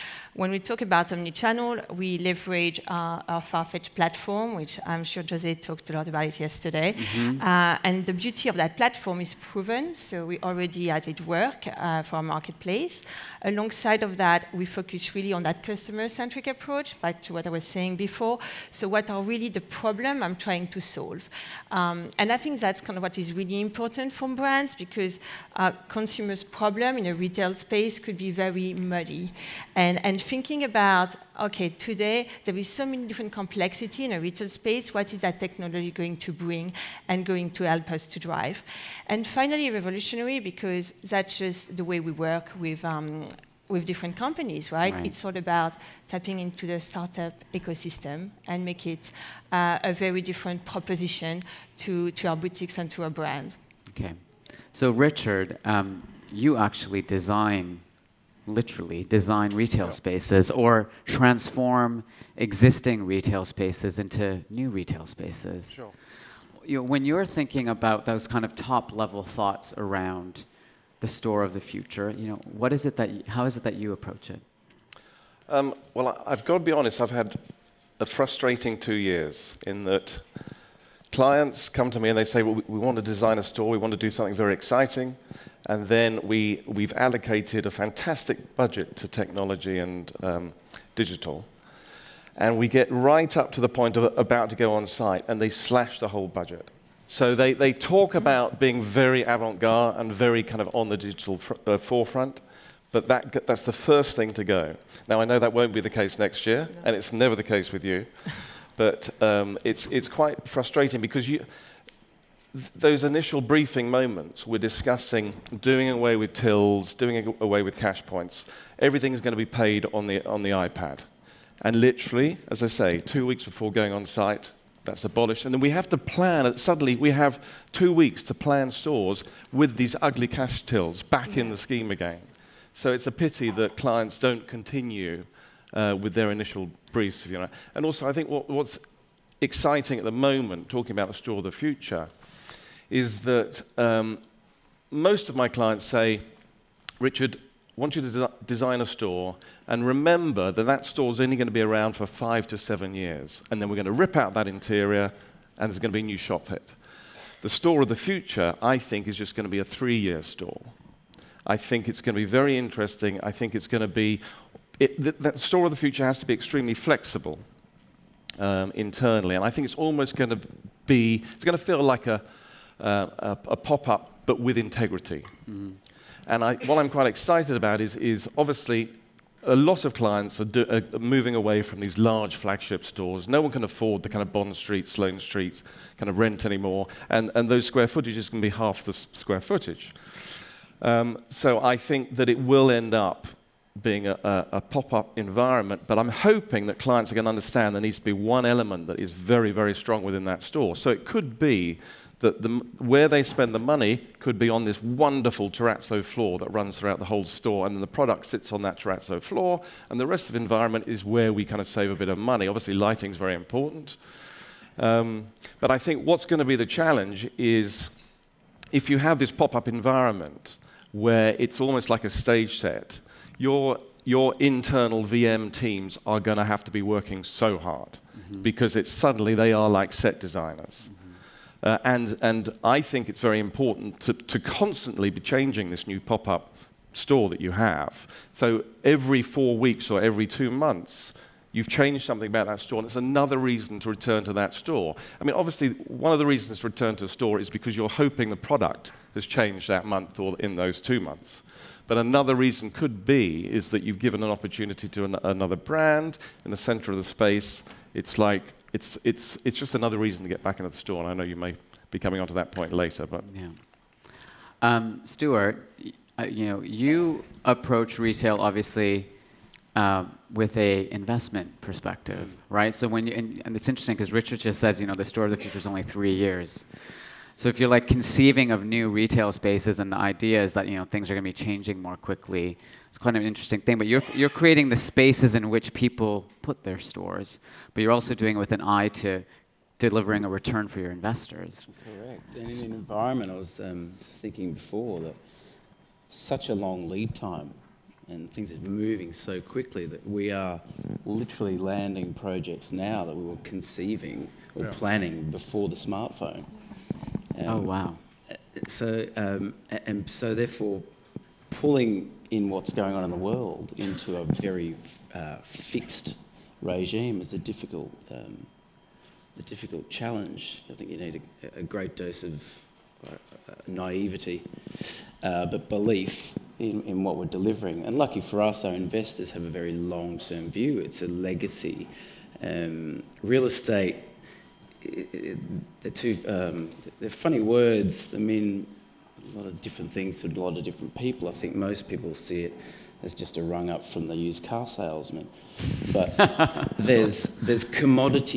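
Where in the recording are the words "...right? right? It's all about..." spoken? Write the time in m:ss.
0:44.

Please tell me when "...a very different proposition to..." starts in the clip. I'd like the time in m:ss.
0:49.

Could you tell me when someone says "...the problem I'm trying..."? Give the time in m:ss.
0:19.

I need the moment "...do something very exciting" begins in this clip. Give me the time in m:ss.
1:23.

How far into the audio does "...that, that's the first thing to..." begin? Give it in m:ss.
1:43.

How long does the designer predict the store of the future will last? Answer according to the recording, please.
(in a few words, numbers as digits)
3 years.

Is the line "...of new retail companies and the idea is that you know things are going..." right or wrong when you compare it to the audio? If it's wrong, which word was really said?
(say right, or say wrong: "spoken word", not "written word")
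wrong: "spaces", not "companies".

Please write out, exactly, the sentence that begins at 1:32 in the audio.
And we get right up to the point of about to go on site, and they slash the whole budget.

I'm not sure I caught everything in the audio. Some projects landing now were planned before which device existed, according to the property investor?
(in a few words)
smartphone.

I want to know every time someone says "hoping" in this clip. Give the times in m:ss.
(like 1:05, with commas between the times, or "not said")
3:16, 4:07.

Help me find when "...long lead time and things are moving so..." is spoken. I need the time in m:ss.
4:56.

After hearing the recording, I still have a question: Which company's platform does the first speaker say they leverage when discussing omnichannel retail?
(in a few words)
Farfetch.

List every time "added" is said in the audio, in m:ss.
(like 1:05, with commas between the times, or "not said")
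0:10.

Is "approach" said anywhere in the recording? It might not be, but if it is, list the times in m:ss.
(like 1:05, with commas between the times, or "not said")
0:16, 1:13, 4:27.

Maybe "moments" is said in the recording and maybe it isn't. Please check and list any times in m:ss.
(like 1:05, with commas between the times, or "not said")
1:53, 2:20.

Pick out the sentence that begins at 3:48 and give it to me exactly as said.
because it's suddenly they are like set designers.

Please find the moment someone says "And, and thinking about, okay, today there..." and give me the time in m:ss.
0:29.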